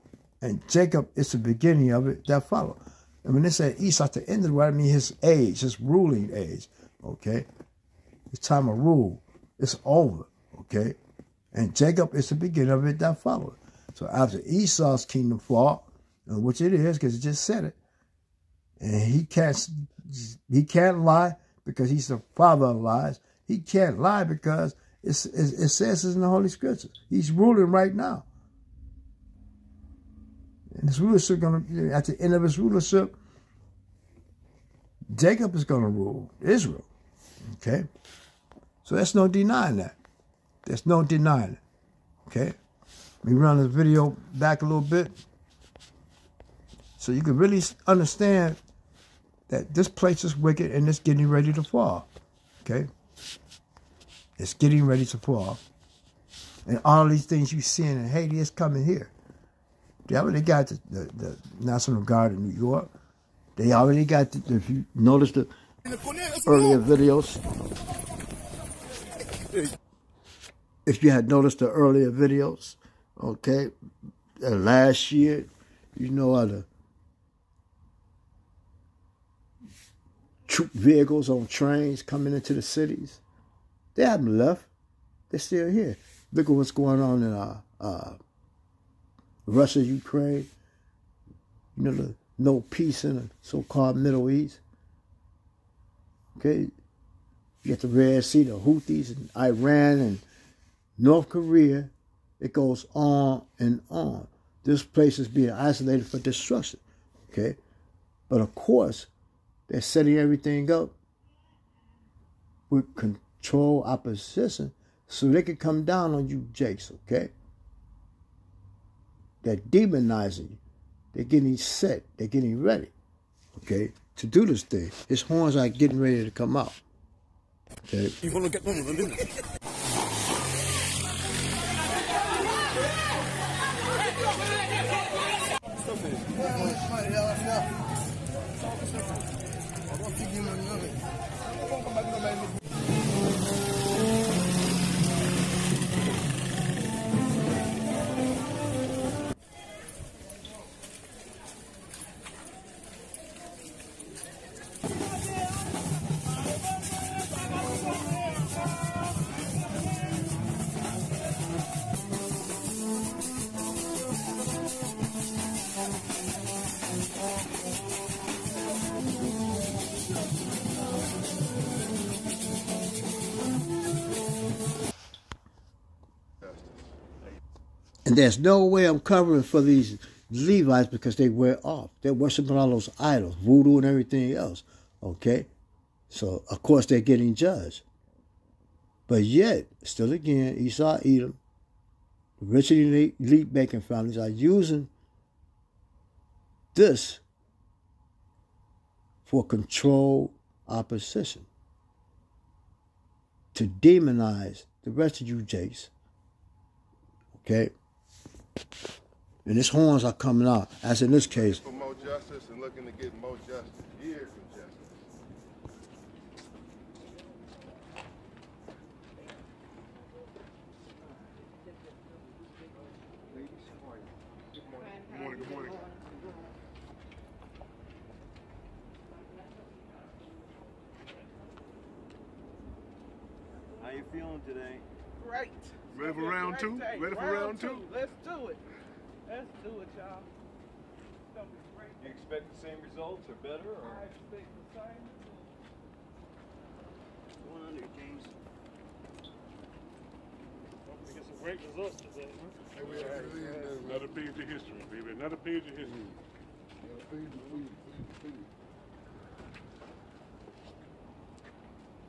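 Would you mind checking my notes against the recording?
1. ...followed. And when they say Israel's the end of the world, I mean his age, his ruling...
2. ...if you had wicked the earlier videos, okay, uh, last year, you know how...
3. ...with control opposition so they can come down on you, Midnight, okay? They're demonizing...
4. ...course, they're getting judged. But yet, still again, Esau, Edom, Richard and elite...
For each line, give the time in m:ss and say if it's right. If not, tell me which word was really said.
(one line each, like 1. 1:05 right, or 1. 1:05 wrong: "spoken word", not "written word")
1. 0:02 wrong: "Esau", not "Israel"
2. 1:10 wrong: "noticed", not "wicked"
3. 1:52 wrong: "Jakes", not "Midnight"
4. 3:06 right.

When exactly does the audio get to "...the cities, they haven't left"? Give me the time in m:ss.
1:22.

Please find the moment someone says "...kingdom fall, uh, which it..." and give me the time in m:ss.
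0:15.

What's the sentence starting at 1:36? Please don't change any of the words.
Okay, you got the Red Sea, the Houthis, and Iran, and North Korea, it goes on and on.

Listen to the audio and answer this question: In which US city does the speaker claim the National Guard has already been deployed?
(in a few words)
New York.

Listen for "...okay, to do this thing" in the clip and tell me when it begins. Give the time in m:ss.
2:03.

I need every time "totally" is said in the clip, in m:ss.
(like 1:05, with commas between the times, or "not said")
not said.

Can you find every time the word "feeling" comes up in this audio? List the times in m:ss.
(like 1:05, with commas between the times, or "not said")
3:54.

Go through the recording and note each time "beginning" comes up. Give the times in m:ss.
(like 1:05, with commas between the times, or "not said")
0:01, 0:12.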